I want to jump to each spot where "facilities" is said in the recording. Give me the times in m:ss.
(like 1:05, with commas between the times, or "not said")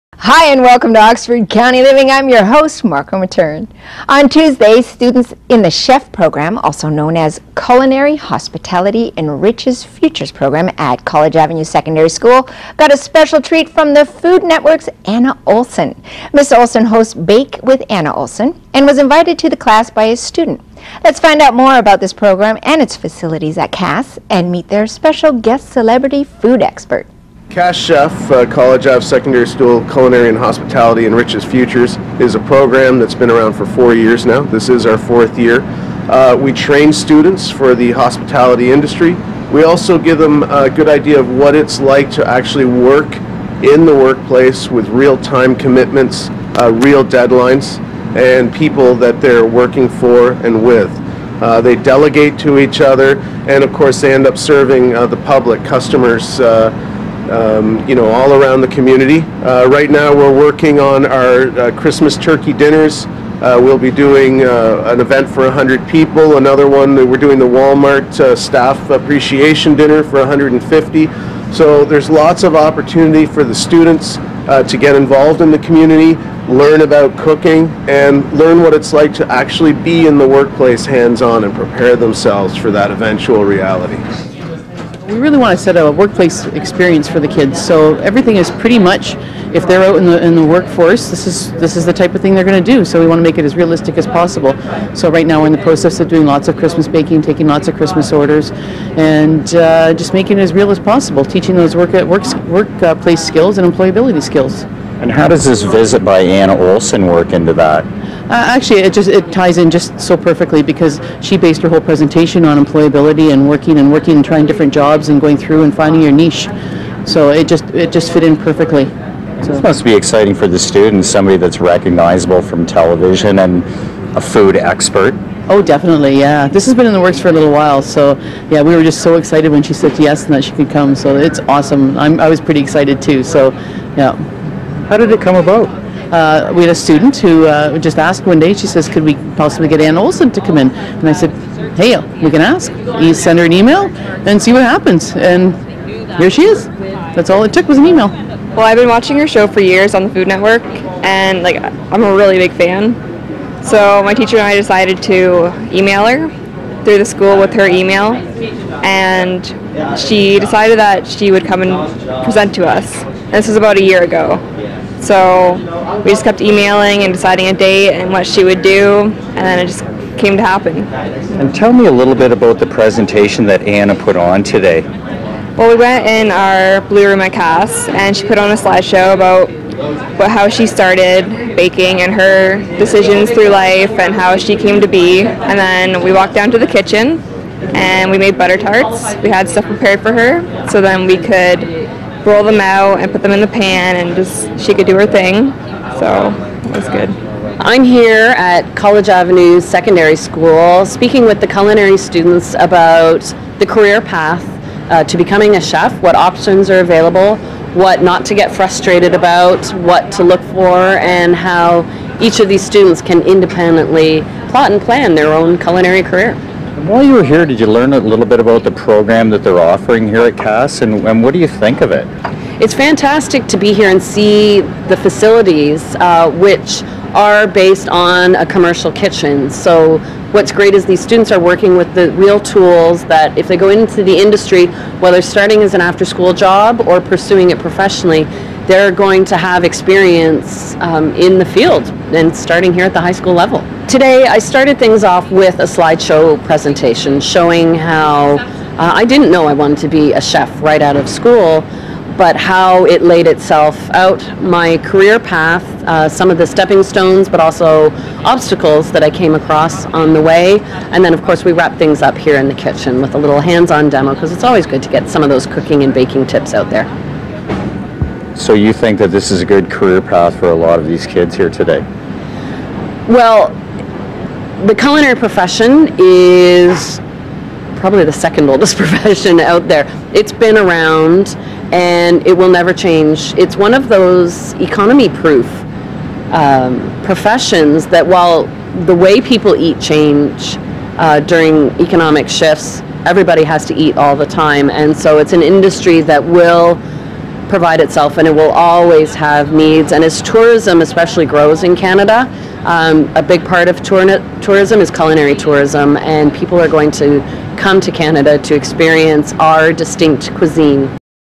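0:22, 3:44.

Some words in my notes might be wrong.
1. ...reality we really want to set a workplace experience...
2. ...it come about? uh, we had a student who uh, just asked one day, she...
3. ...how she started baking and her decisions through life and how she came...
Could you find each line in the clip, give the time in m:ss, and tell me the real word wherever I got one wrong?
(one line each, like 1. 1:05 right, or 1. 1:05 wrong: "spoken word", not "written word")
1. 1:23 right
2. 2:15 right
3. 3:00 right.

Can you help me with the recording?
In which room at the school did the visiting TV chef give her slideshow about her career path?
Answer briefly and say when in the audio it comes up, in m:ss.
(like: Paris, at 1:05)
Blue Room, at 2:56.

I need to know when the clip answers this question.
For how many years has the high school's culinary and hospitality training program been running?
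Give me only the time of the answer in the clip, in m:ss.
0:33.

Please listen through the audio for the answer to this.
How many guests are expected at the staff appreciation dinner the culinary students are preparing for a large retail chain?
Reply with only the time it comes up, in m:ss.
1:10.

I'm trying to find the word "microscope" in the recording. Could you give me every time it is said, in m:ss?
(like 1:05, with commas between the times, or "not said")
not said.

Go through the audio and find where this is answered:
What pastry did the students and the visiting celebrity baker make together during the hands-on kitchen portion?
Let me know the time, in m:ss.
3:08.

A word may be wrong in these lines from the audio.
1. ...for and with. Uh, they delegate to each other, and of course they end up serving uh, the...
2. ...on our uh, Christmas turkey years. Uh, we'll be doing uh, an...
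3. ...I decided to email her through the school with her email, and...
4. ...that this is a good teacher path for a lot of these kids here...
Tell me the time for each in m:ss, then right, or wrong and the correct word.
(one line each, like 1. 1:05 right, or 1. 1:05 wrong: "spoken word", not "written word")
1. 0:49 right
2. 1:00 wrong: "dinners", not "years"
3. 2:34 right
4. 4:28 wrong: "career", not "teacher".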